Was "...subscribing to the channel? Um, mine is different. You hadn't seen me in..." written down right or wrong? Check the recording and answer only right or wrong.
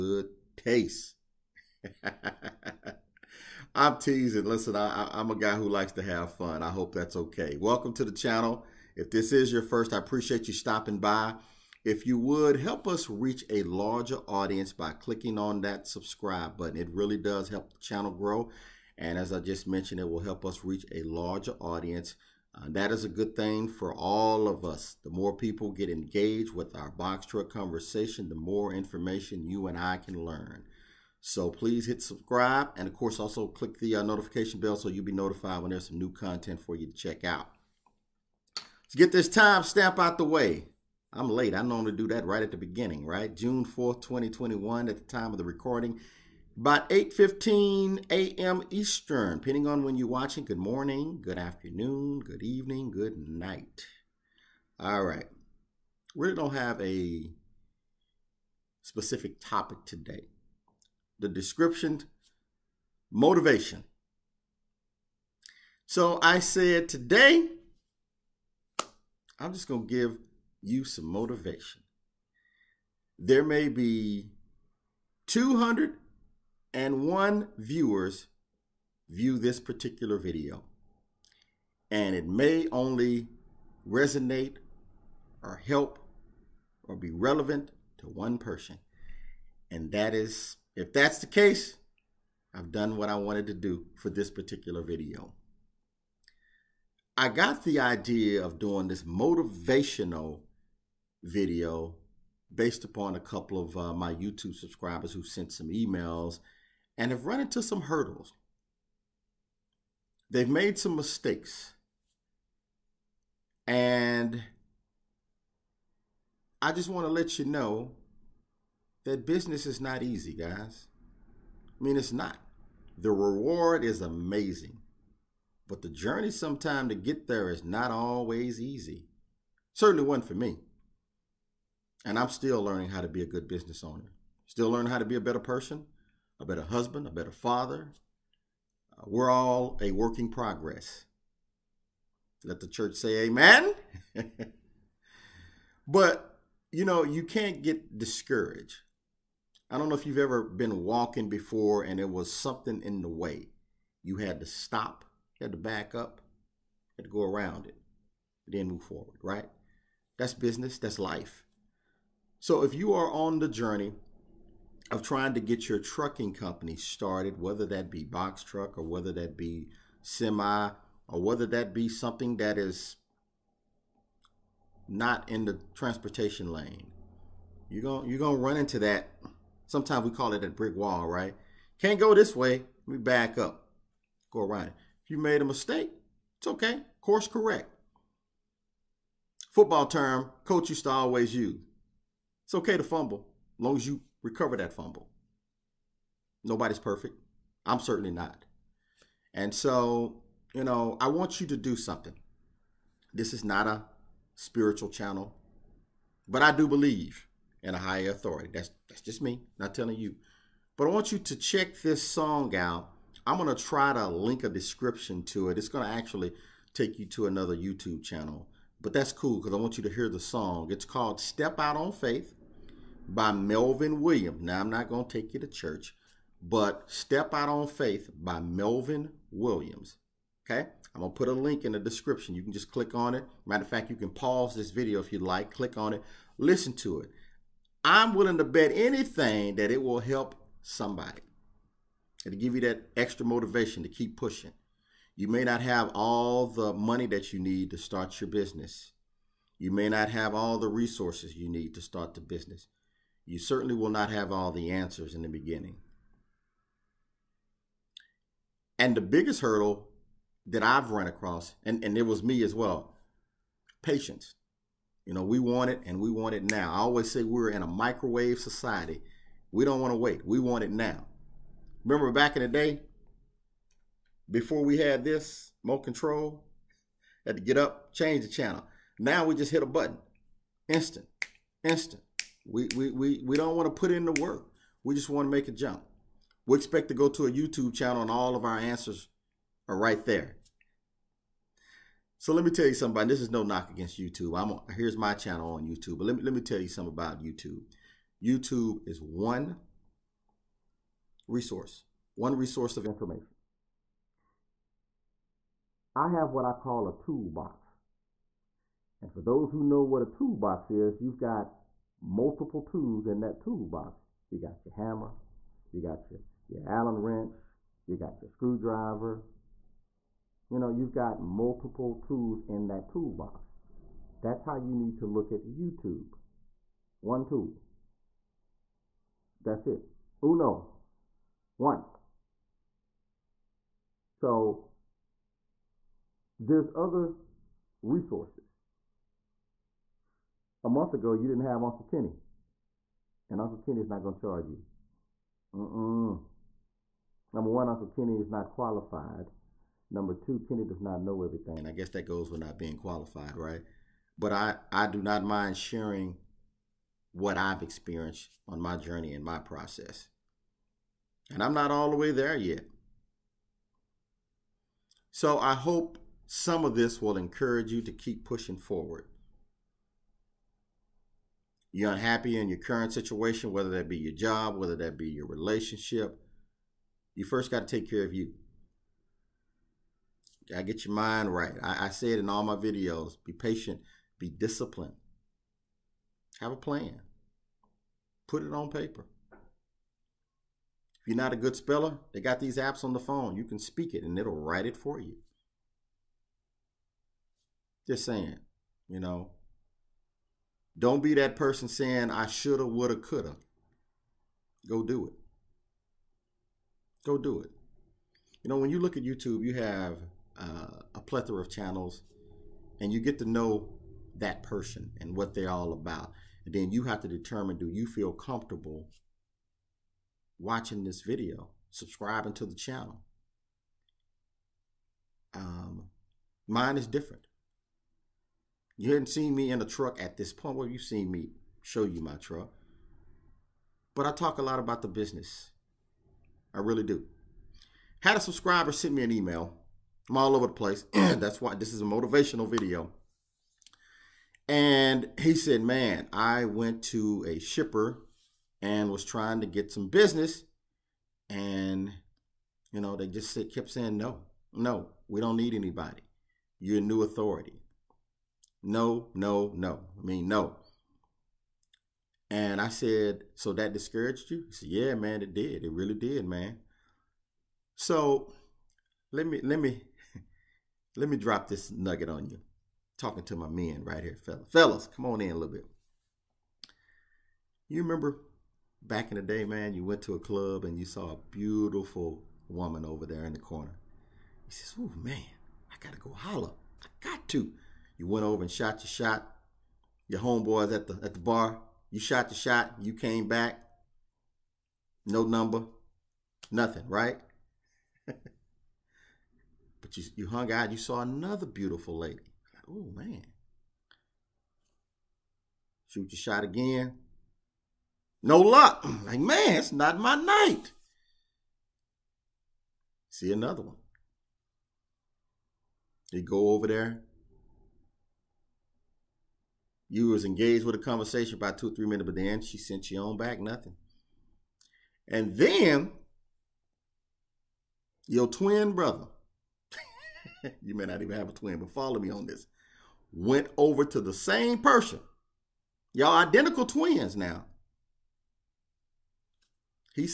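right.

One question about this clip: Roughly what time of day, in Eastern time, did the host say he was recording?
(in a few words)
8:15 a.m.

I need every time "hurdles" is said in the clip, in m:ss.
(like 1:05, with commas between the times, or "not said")
1:47, 4:19.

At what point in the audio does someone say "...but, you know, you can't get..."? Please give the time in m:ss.
2:25.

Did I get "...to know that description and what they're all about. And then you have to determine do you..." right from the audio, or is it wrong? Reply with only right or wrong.
wrong.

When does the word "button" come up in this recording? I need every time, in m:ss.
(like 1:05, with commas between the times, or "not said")
0:16, 4:39.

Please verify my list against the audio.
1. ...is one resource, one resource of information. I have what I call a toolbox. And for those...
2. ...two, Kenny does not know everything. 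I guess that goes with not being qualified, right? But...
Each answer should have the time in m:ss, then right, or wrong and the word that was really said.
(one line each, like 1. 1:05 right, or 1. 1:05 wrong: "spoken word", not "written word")
1. 4:58 right
2. 5:50 right.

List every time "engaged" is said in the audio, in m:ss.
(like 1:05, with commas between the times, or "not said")
0:25, 8:40.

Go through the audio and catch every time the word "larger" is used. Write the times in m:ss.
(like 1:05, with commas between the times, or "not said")
0:13, 0:21.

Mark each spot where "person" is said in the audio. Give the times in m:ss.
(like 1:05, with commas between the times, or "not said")
1:28, 2:15, 6:41, 6:54, 8:54.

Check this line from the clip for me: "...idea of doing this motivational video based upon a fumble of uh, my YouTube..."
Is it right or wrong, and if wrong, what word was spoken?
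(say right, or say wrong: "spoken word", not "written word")
wrong: "couple", not "fumble".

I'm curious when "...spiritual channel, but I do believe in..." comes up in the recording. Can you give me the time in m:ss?
3:24.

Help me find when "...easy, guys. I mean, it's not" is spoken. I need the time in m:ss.
2:00.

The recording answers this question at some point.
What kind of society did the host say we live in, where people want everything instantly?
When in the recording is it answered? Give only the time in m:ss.
4:27.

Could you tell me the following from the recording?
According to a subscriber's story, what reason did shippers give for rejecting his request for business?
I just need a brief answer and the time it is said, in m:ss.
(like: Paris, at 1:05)
new authority, at 7:36.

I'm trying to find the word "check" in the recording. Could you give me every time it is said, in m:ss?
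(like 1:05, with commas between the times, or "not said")
0:36, 3:31.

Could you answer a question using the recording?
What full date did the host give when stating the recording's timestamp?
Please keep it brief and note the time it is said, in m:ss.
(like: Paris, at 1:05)
June 4th, 2021, at 0:43.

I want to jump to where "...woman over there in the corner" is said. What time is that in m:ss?
8:02.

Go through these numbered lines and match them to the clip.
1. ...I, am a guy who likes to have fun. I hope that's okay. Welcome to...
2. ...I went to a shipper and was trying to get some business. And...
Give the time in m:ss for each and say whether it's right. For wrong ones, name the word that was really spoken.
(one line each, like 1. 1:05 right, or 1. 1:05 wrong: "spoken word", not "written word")
1. 0:04 right
2. 7:26 right.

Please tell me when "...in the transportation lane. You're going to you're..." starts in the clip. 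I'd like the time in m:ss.
2:55.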